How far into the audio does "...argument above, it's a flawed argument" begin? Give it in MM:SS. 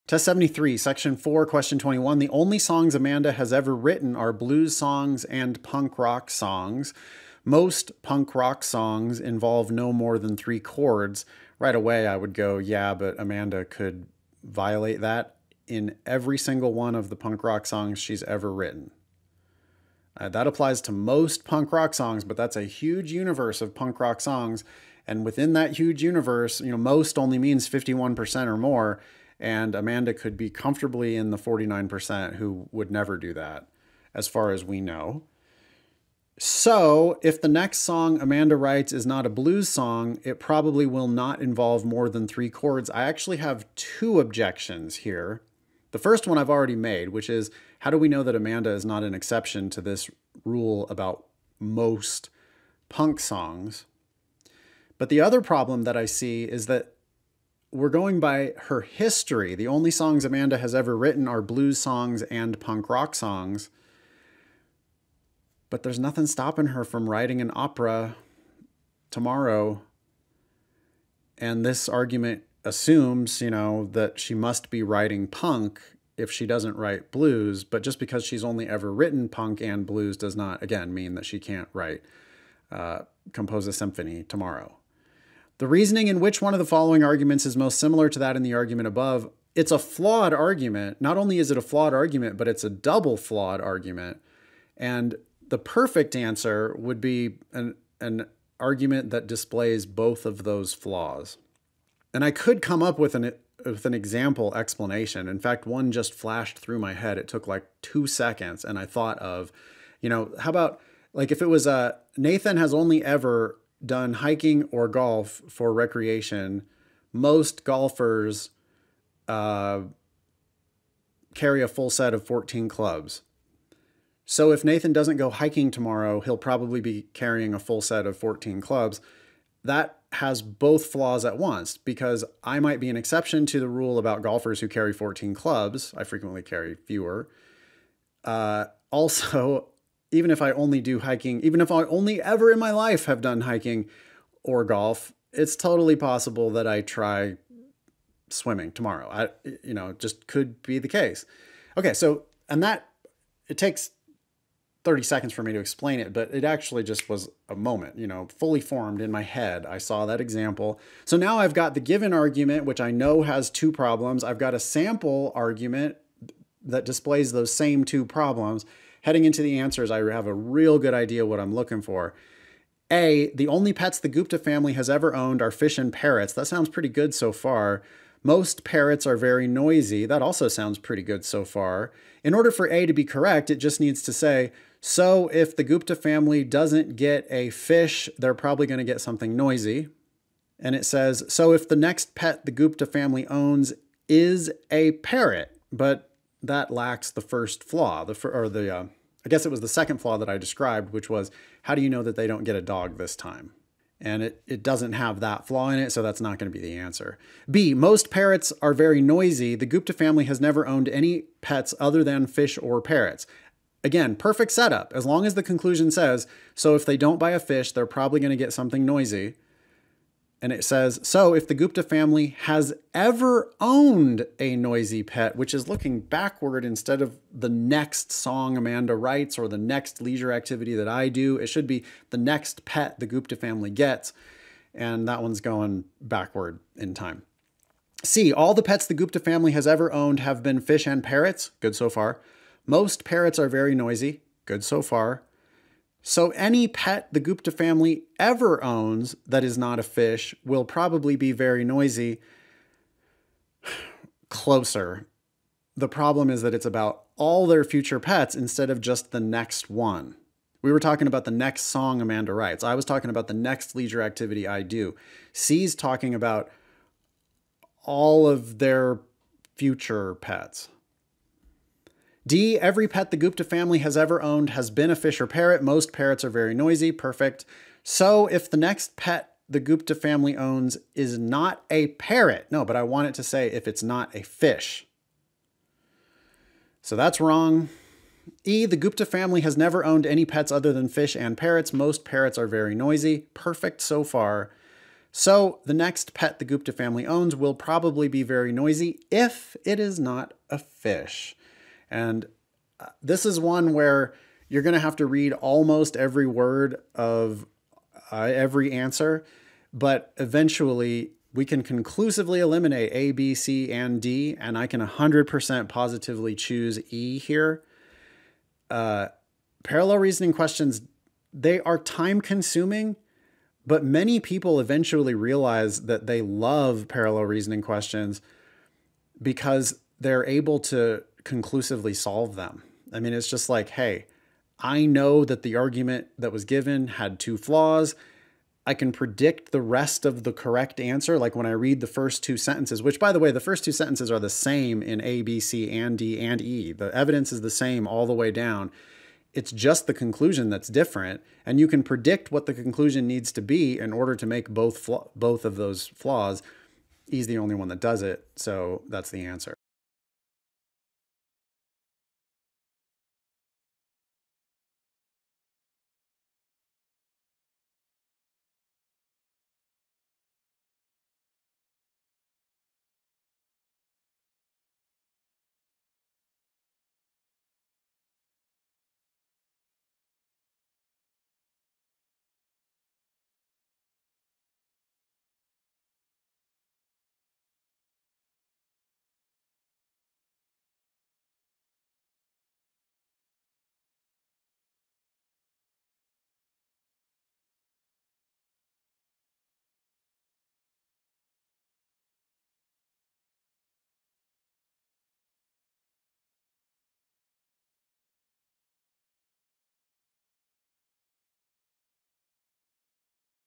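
01:28.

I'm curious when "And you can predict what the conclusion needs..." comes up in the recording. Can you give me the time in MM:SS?
05:51.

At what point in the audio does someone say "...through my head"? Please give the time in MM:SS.
01:46.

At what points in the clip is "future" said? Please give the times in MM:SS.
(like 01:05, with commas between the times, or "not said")
04:17, 04:29.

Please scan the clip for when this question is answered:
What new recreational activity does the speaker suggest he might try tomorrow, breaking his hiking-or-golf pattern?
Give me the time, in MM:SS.
02:28.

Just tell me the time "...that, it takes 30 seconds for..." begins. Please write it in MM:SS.
02:32.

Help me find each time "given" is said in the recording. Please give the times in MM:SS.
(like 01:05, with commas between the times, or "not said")
02:41, 05:36.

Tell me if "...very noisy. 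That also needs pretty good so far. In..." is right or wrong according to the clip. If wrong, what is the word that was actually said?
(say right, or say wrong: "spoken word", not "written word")
wrong: "sounds", not "needs".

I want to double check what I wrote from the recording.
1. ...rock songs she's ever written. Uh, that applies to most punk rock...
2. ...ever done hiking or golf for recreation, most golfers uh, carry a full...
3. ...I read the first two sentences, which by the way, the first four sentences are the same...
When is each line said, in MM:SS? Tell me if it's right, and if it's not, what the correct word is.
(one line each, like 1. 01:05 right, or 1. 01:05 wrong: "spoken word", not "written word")
1. 00:17 right
2. 01:53 right
3. 05:41 wrong: "two", not "four".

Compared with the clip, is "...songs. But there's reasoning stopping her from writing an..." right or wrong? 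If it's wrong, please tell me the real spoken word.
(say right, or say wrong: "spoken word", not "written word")
wrong: "nothing", not "reasoning".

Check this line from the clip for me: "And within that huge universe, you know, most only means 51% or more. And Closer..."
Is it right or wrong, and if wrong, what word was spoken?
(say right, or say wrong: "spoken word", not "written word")
wrong: "Amanda", not "Closer".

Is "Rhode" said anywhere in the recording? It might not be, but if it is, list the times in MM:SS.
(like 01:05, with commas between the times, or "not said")
not said.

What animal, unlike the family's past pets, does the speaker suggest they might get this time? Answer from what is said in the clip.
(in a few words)
a dog.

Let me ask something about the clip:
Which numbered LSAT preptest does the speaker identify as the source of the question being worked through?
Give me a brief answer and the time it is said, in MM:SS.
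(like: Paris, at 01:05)
73, at 00:00.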